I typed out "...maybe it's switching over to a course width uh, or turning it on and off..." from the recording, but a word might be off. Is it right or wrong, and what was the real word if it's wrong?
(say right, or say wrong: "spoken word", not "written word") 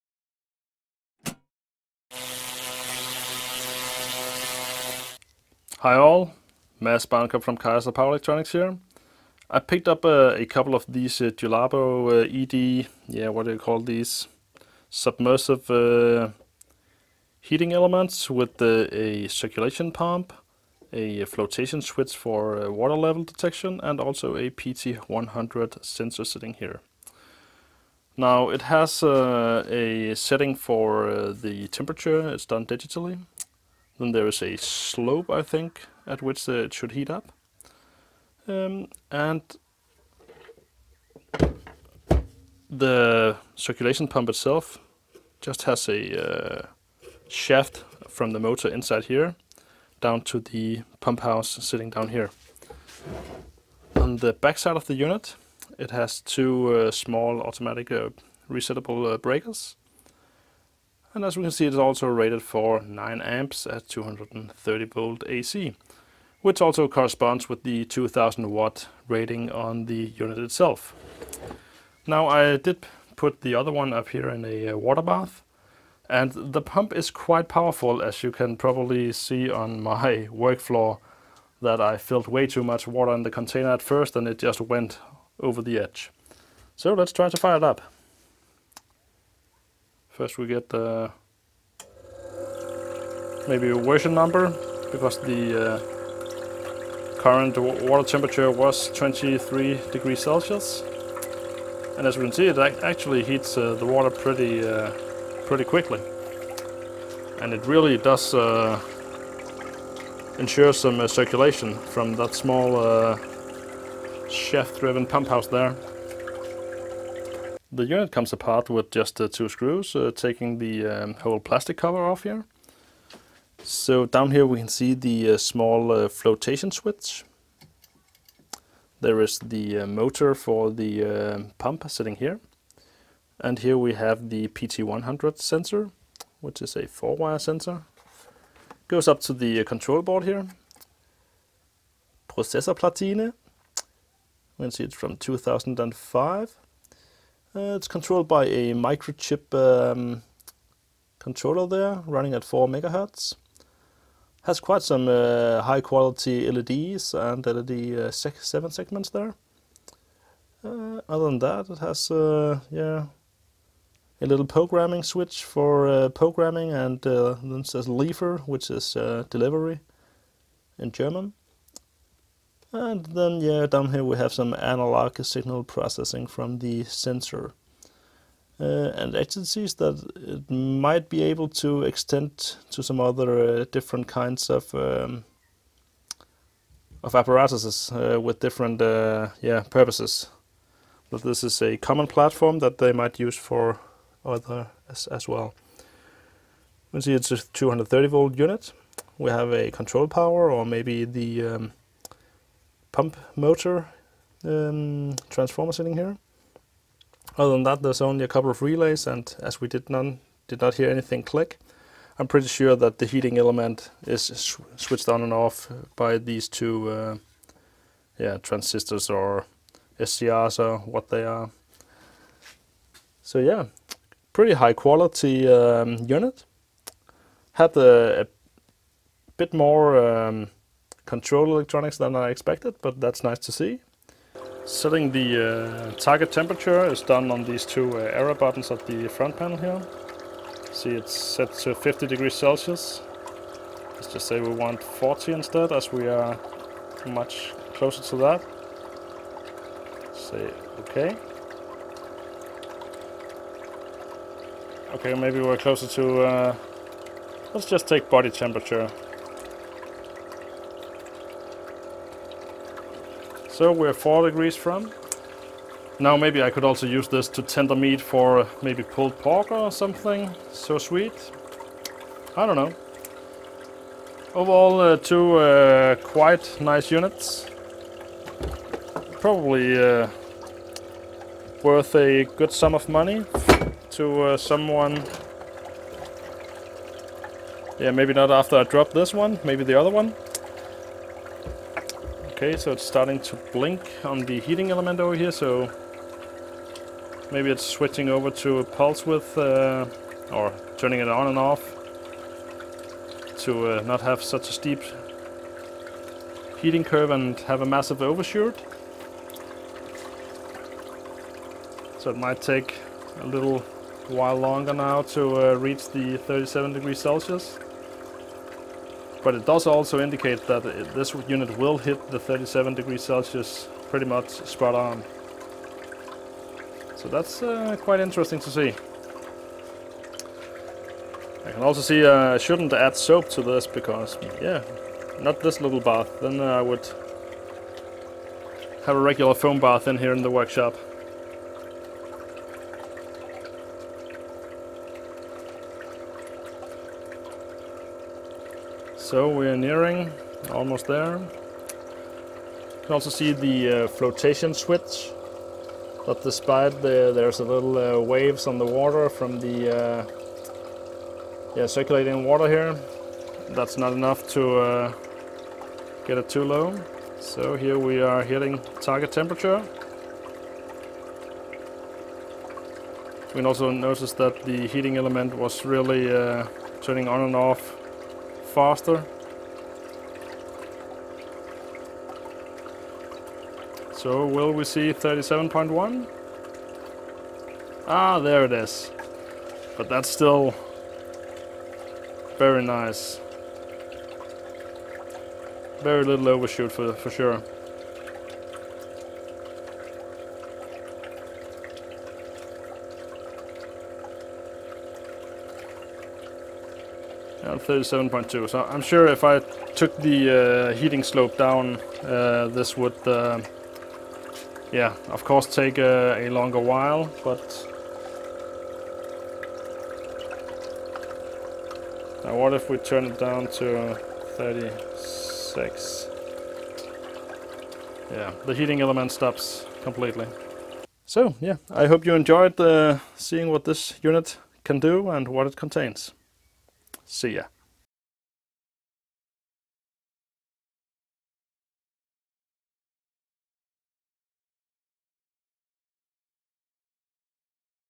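wrong: "pulse", not "course".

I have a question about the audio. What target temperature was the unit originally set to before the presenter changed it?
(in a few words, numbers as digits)
50 degrees Celsius.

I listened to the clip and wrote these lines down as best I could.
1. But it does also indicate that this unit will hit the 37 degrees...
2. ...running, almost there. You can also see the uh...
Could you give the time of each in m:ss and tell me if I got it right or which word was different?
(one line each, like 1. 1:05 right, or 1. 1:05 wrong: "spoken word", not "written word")
1. 5:19 right
2. 5:49 wrong: "nearing", not "running".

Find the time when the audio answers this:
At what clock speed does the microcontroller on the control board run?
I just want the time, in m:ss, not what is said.
2:32.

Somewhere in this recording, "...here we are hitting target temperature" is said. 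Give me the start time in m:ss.
6:07.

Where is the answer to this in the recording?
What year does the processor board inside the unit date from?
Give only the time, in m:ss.
2:25.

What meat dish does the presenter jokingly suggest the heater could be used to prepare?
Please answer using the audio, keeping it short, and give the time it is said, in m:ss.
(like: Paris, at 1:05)
pulled pork, at 4:28.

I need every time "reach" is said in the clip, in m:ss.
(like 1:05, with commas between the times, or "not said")
5:15.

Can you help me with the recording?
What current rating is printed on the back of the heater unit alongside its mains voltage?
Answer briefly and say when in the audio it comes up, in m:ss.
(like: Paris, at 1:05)
9 amps, at 1:02.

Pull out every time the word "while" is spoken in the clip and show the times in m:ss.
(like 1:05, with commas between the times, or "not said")
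5:14, 6:56.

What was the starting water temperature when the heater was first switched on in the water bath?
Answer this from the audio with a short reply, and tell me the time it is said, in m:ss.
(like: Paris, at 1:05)
23 degrees Celsius, at 1:38.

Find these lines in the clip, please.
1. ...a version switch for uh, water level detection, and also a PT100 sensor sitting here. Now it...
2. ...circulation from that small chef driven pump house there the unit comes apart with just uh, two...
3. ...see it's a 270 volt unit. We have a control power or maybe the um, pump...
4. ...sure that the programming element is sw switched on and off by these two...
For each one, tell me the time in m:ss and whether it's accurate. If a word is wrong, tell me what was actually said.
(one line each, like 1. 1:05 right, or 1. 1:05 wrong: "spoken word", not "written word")
1. 0:20 wrong: "flotation", not "version"
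2. 1:51 right
3. 3:17 wrong: "230", not "270"
4. 3:32 wrong: "heating", not "programming".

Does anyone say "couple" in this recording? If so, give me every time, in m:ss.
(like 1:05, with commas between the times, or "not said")
0:10, 3:28.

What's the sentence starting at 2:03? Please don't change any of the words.
So down here we can see the uh, small uh, flotation switch.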